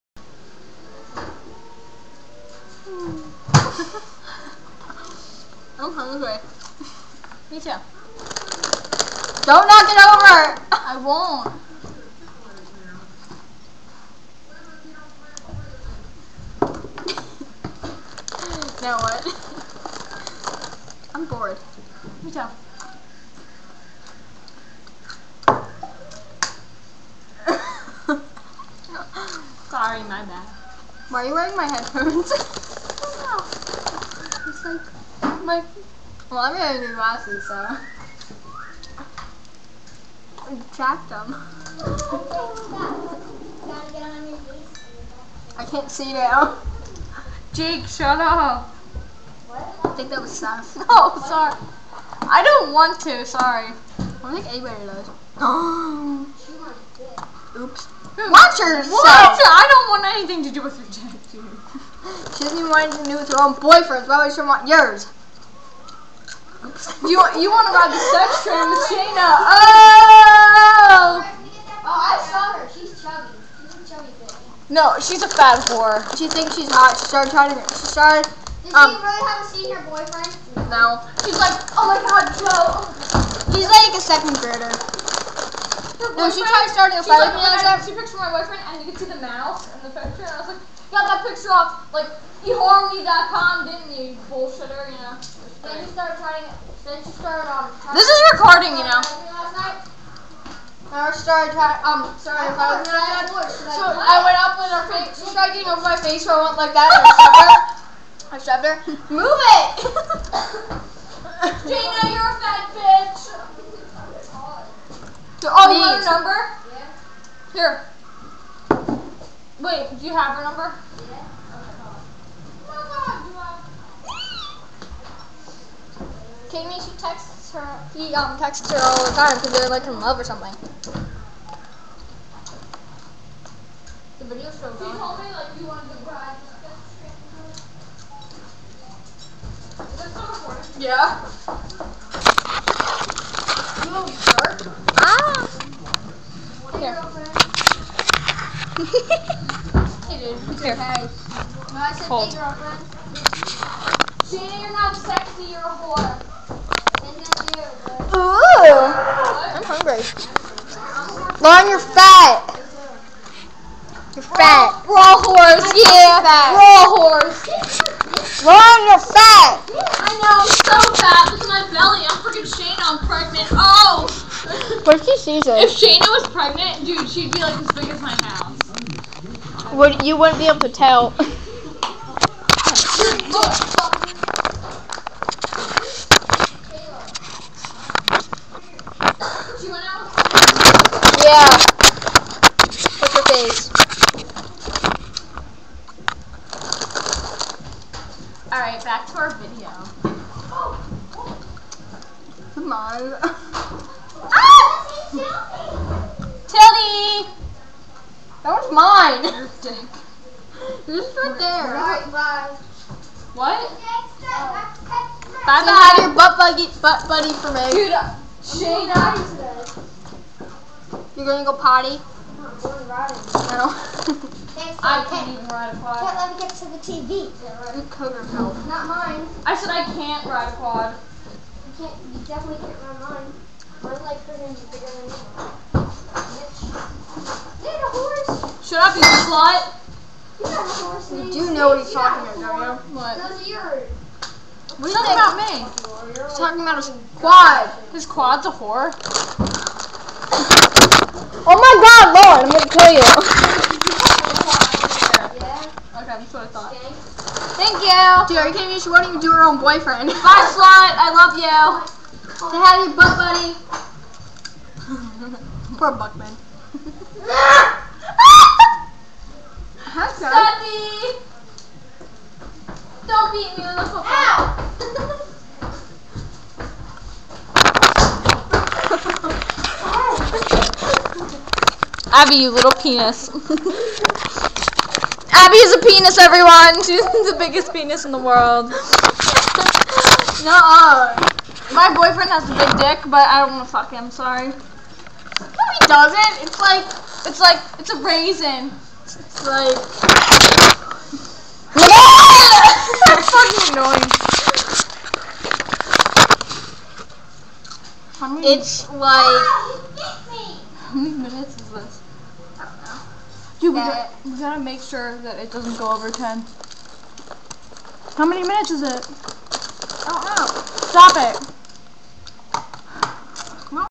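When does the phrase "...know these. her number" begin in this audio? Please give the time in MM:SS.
01:55.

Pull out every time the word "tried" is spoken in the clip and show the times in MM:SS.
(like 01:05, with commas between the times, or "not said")
01:26, 01:45.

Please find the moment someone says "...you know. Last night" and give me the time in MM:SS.
01:38.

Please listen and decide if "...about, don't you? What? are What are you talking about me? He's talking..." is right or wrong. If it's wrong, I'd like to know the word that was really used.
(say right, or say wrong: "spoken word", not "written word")
right.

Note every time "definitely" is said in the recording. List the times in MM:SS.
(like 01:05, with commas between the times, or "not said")
03:52.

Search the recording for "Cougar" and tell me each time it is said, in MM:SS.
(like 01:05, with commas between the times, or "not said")
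03:47.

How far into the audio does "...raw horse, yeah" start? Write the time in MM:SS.
02:44.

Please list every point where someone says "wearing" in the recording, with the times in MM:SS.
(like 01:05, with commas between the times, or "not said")
00:31, 00:36.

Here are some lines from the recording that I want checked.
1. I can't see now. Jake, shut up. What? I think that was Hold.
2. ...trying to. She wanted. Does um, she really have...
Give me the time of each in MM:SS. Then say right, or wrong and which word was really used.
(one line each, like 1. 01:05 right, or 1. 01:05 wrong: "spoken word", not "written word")
1. 00:45 wrong: "Seth", not "Hold"
2. 01:17 wrong: "started", not "wanted".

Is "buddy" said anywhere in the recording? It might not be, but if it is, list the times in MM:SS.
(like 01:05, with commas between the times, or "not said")
03:37, 04:23.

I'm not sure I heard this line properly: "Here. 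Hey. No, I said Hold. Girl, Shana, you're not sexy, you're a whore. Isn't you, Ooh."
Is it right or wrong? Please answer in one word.
right.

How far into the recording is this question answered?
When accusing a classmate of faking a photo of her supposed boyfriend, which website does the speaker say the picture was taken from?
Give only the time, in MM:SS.
01:32.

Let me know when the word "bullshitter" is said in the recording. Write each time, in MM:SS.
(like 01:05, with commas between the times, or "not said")
01:34.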